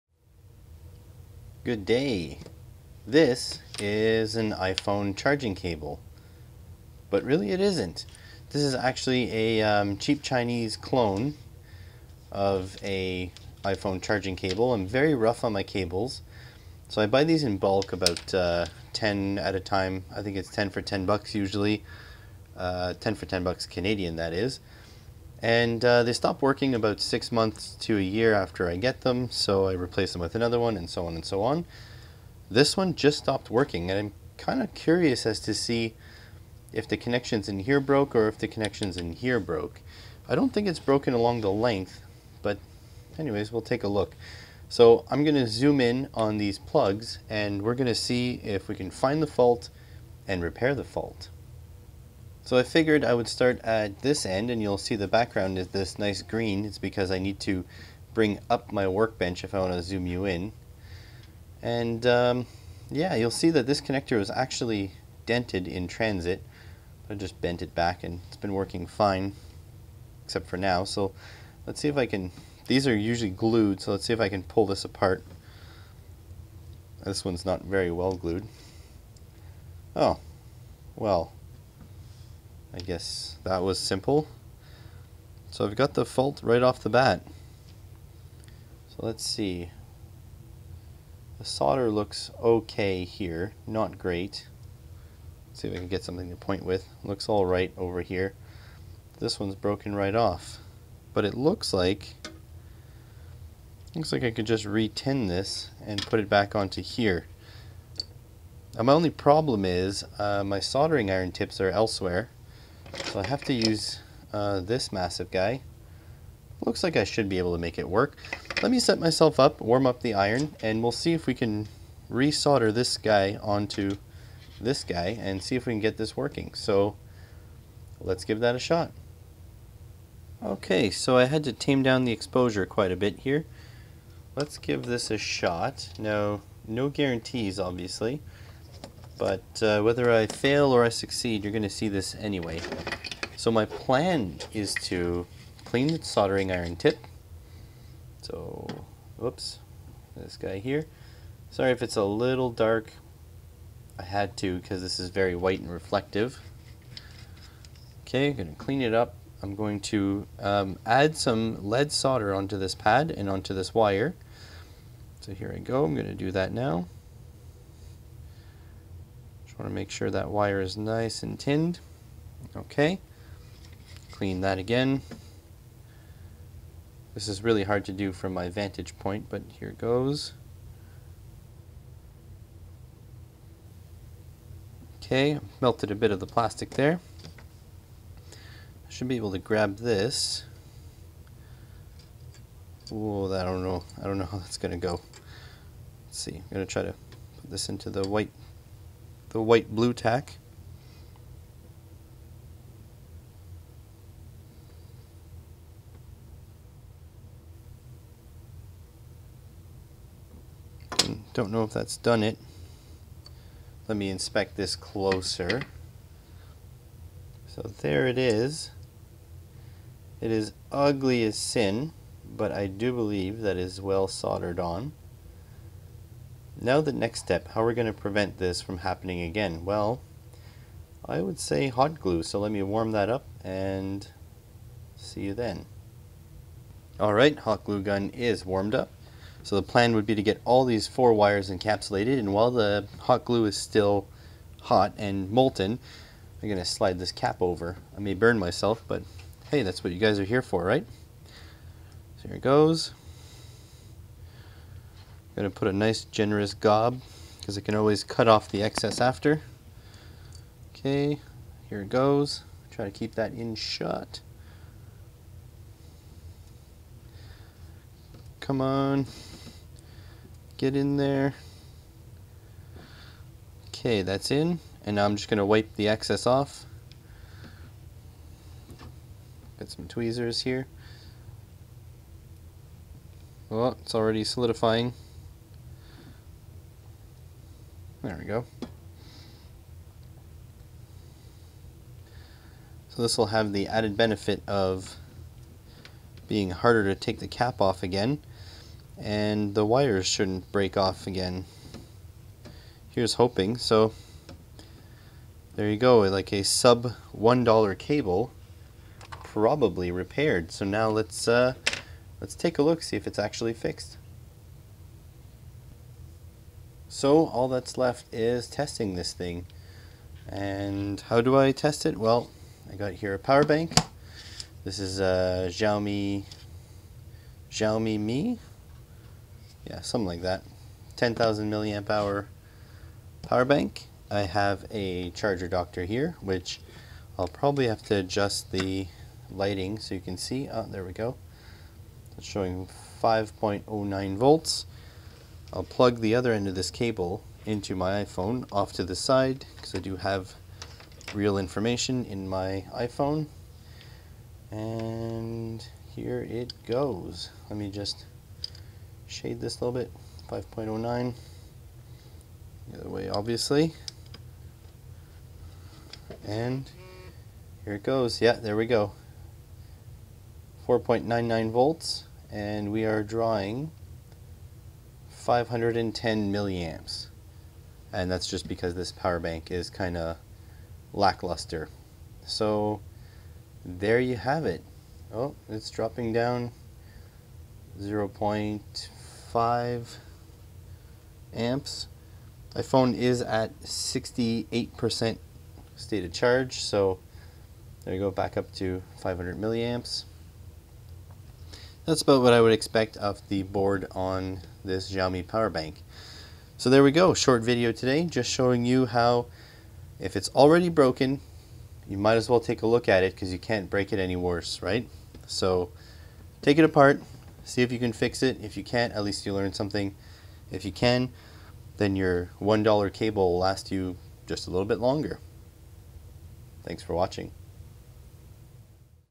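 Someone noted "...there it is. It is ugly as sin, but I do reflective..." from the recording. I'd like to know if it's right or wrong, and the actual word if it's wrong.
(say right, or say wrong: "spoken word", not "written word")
wrong: "believe", not "reflective".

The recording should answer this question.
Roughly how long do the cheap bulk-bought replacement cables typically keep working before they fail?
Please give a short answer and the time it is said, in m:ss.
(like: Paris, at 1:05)
6 months to a year, at 0:27.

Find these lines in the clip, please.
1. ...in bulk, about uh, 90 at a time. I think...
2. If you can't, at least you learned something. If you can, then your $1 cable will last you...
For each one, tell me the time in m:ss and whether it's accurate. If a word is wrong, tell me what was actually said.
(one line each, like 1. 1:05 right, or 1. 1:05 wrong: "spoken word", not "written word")
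1. 0:17 wrong: "10", not "90"
2. 6:58 right.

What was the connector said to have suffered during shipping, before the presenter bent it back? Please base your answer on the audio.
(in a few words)
Dented.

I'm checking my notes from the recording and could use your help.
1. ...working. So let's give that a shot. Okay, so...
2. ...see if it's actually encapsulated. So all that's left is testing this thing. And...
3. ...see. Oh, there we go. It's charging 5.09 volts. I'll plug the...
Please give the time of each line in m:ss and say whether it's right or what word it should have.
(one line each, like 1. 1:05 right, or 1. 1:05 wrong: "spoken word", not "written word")
1. 2:06 right
2. 5:12 wrong: "fixed", not "encapsulated"
3. 5:40 wrong: "showing", not "charging".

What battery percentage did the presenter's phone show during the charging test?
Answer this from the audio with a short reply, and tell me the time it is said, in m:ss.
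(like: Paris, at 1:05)
68%, at 6:33.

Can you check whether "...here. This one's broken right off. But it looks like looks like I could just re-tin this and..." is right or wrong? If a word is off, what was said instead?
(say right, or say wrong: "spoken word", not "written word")
right.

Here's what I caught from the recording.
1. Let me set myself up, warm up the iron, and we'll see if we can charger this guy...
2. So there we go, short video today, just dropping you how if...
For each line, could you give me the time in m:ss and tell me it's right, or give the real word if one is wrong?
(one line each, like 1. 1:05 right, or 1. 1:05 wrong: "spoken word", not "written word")
1. 1:58 wrong: "resolder", not "charger"
2. 6:46 wrong: "showing", not "dropping".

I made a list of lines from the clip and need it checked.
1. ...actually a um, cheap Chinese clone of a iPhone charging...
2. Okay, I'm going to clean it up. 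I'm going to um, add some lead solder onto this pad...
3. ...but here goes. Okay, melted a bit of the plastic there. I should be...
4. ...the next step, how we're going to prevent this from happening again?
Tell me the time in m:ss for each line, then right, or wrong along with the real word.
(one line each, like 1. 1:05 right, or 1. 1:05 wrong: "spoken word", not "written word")
1. 0:08 right
2. 2:38 right
3. 2:59 right
4. 3:46 right.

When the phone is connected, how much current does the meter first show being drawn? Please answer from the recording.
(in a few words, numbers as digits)
510 milliamps.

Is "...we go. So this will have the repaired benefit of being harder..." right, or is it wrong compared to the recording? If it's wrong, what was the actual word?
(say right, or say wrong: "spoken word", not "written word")
wrong: "added", not "repaired".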